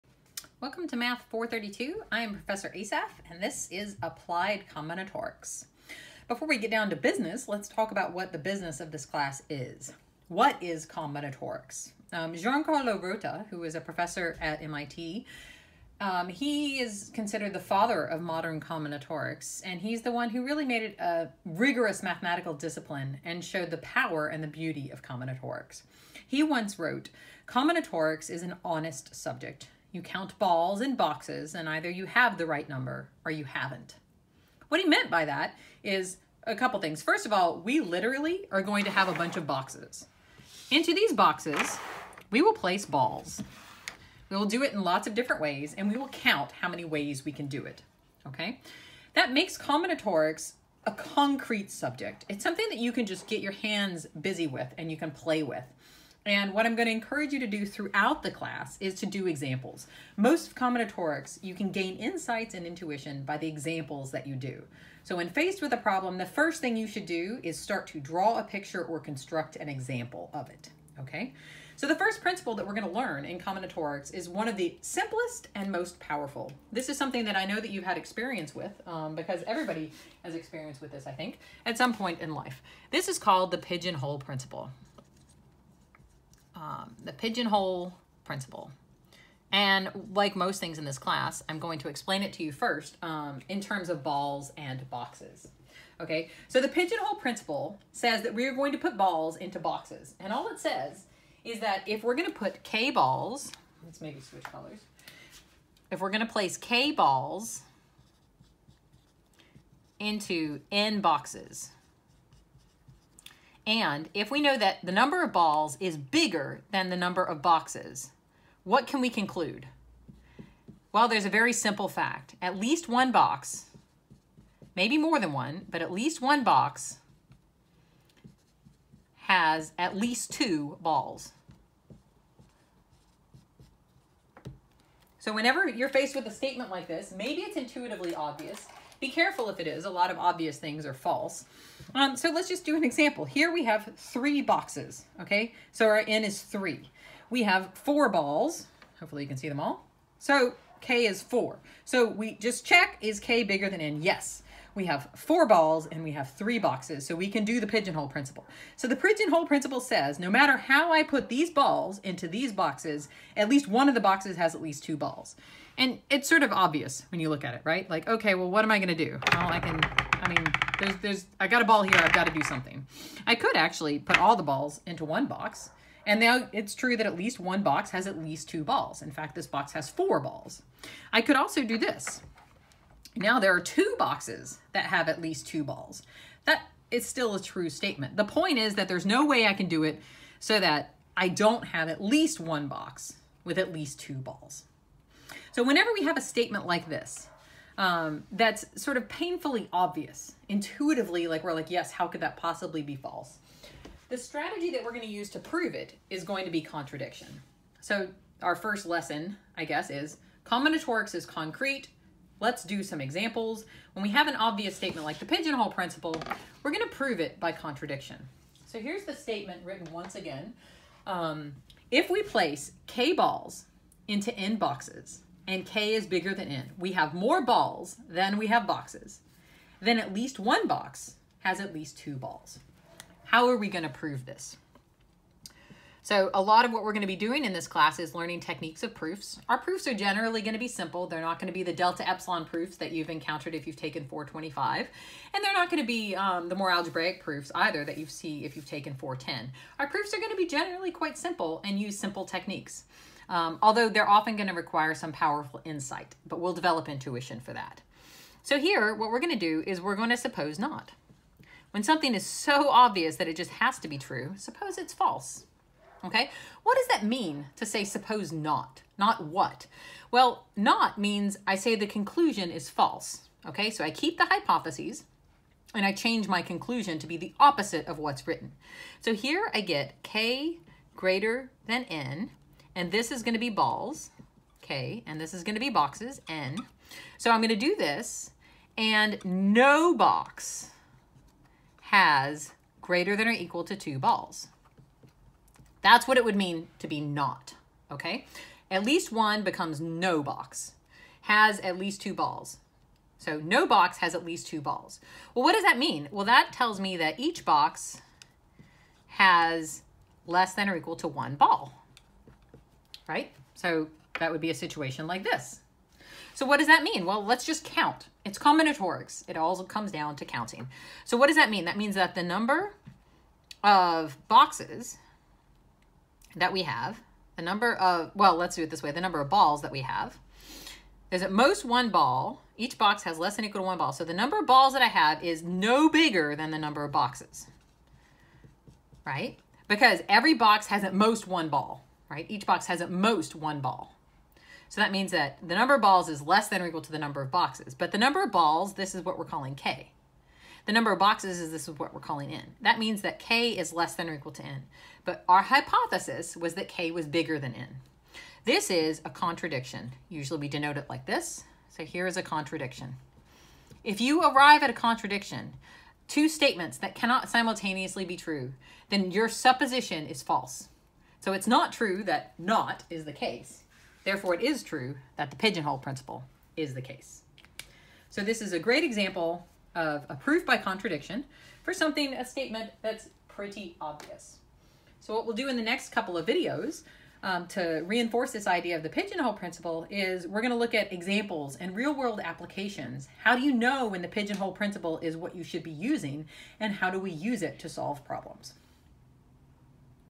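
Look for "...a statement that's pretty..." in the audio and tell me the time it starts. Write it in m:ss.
6:22.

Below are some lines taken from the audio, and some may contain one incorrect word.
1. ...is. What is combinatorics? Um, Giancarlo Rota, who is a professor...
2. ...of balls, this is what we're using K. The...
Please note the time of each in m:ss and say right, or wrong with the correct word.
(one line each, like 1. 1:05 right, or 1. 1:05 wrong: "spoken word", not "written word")
1. 0:09 right
2. 5:48 wrong: "calling", not "using".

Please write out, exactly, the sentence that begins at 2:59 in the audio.
In fact, this box has four balls.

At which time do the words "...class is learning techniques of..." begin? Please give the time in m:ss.
3:57.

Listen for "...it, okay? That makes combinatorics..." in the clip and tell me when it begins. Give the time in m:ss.
0:47.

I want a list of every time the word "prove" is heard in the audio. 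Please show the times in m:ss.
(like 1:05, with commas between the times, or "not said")
3:25, 3:36, 3:53.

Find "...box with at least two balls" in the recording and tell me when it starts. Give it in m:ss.
3:12.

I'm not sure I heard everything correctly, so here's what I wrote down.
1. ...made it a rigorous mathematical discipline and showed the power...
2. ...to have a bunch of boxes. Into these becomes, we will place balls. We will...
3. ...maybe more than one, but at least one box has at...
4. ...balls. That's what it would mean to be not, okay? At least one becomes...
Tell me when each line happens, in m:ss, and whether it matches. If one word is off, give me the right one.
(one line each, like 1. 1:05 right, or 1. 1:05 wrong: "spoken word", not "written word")
1. 0:20 right
2. 0:38 wrong: "boxes", not "becomes"
3. 2:04 right
4. 4:53 right.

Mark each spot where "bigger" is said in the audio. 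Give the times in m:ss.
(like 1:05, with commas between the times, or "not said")
1:55, 2:33, 3:46, 5:35, 5:57.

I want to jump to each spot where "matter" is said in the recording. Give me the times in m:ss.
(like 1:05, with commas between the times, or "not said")
2:40.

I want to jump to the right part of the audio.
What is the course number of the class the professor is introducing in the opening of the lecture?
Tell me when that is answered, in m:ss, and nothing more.
0:00.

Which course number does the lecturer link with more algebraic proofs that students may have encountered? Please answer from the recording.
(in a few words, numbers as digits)
410.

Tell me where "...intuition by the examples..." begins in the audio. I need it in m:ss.
1:02.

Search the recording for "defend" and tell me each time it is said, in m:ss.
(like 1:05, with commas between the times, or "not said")
not said.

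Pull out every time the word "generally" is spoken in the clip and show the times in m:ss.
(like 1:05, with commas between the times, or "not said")
3:59, 4:10.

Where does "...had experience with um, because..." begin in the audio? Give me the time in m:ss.
1:17.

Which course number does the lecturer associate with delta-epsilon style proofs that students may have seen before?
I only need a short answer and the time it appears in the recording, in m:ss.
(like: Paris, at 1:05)
425, at 4:04.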